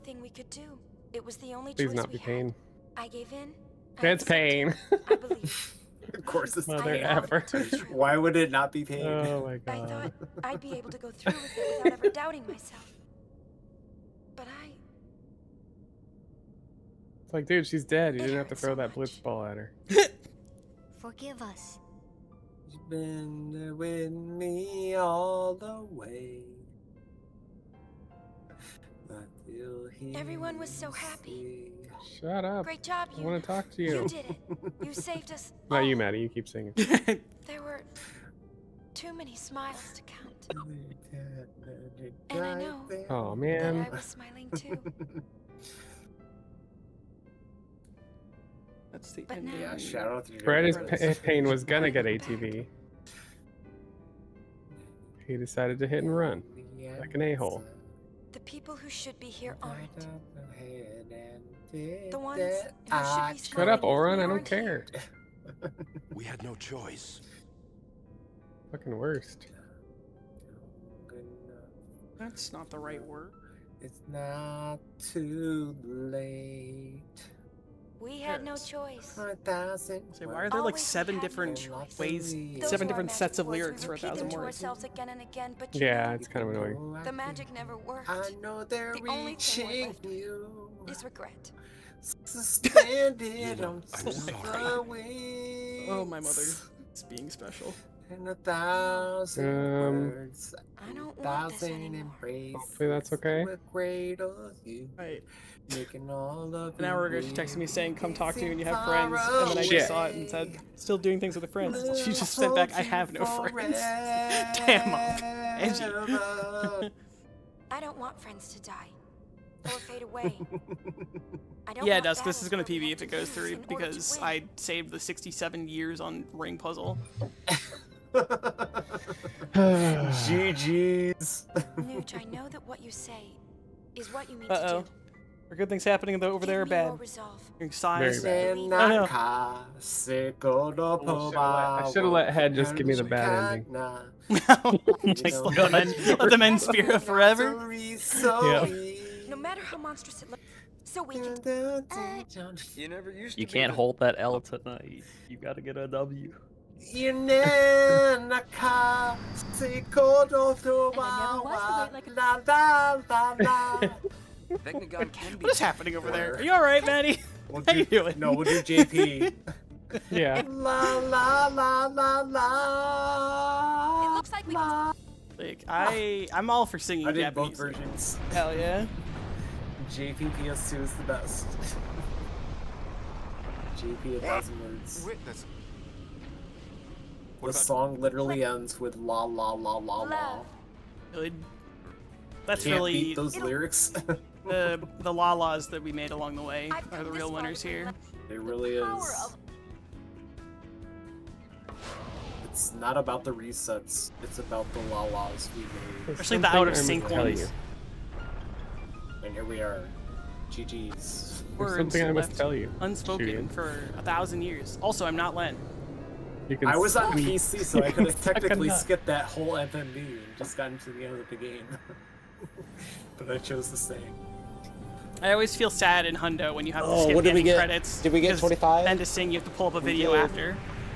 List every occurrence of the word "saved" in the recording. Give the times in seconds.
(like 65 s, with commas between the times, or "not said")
34 s, 124 s.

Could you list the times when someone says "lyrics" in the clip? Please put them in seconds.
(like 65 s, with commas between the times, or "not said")
83 s, 193 s.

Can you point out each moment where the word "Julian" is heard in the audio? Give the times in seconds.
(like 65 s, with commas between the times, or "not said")
213 s.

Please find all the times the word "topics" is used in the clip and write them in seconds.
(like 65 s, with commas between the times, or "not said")
not said.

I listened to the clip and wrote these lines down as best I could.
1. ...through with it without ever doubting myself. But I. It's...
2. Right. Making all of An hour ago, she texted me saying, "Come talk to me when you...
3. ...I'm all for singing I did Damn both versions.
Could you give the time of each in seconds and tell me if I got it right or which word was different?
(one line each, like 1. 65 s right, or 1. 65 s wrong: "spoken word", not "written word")
1. 11 s right
2. 103 s right
3. 176 s wrong: "Japanese", not "Damn".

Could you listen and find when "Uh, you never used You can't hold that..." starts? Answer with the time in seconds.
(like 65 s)
151 s.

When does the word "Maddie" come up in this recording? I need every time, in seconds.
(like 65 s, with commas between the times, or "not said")
35 s, 166 s.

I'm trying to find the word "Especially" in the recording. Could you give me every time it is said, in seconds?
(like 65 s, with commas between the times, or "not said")
206 s.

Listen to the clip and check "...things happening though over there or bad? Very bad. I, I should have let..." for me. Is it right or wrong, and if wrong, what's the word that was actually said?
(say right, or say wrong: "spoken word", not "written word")
right.